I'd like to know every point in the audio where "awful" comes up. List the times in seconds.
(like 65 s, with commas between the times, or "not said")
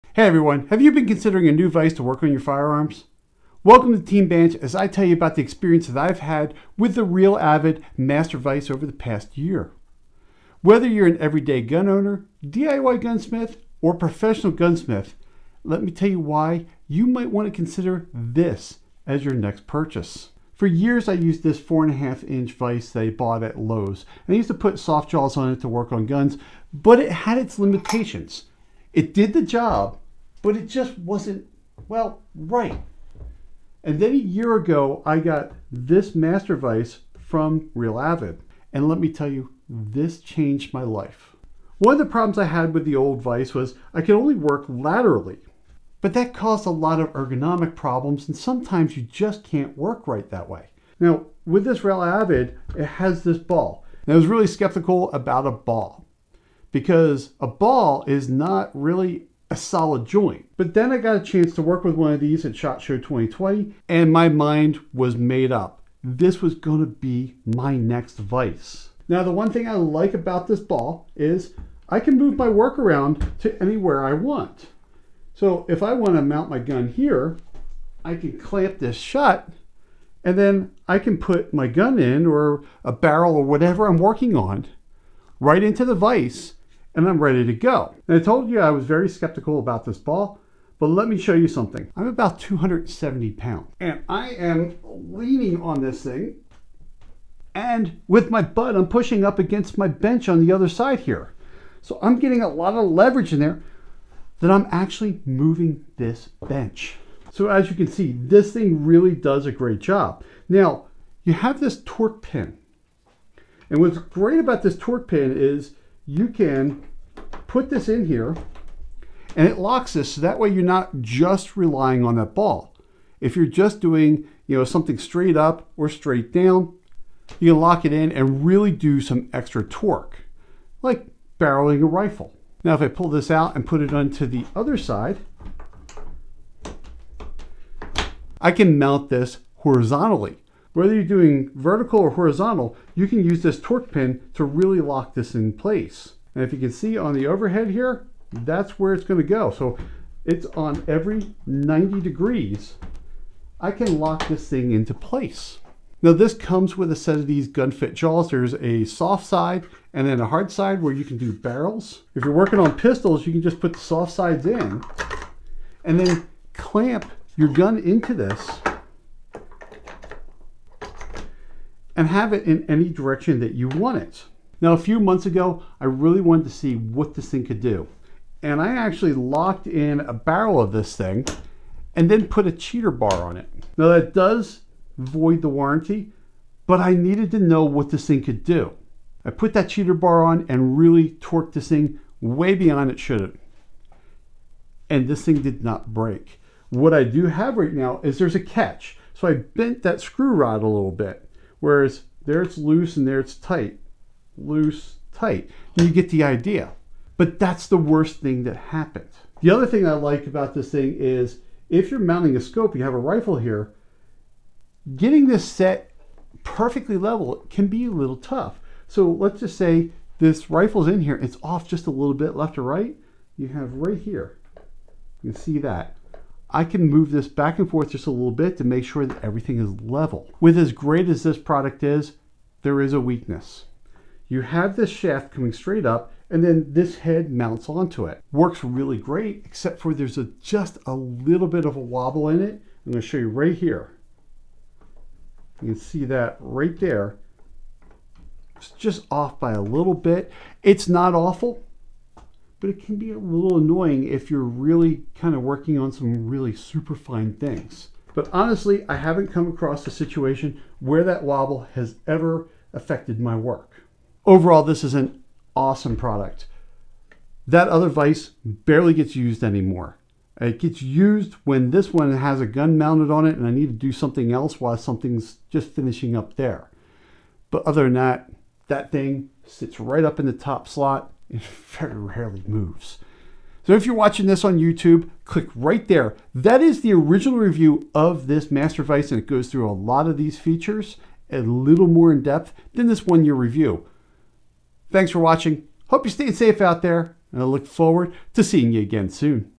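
251 s.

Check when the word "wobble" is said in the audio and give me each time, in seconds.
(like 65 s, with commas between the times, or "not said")
241 s, 261 s.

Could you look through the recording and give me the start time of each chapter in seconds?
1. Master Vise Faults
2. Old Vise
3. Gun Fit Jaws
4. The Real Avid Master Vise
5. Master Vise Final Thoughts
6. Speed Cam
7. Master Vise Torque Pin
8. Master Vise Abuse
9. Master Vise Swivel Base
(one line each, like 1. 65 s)
1. 230 s
2. 20 s
3. 155 s
4. 41 s
5. 264 s
6. 209 s
7. 110 s
8. 174 s
9. 69 s.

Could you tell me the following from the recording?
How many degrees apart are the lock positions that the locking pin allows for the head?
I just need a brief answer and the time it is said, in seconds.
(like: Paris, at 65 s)
90 degrees, at 151 s.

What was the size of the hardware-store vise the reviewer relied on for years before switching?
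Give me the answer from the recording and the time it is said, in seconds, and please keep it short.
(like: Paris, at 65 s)
4.5 inch, at 21 s.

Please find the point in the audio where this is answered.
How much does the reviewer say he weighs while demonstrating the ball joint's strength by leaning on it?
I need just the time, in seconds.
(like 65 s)
92 s.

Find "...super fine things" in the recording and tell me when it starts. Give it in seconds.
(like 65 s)
256 s.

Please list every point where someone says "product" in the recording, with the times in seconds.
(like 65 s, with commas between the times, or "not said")
231 s, 265 s.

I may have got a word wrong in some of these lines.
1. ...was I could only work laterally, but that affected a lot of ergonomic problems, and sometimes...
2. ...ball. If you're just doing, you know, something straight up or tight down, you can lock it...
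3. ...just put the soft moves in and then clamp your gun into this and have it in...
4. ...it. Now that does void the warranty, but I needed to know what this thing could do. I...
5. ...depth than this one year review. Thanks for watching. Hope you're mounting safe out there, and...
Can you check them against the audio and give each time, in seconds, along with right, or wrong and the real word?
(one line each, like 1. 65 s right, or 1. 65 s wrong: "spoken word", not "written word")
1. 43 s wrong: "caused", not "affected"
2. 122 s wrong: "straight", not "tight"
3. 163 s wrong: "sides", not "moves"
4. 183 s right
5. 292 s wrong: "staying", not "mounting".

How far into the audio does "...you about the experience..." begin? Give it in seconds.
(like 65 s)
5 s.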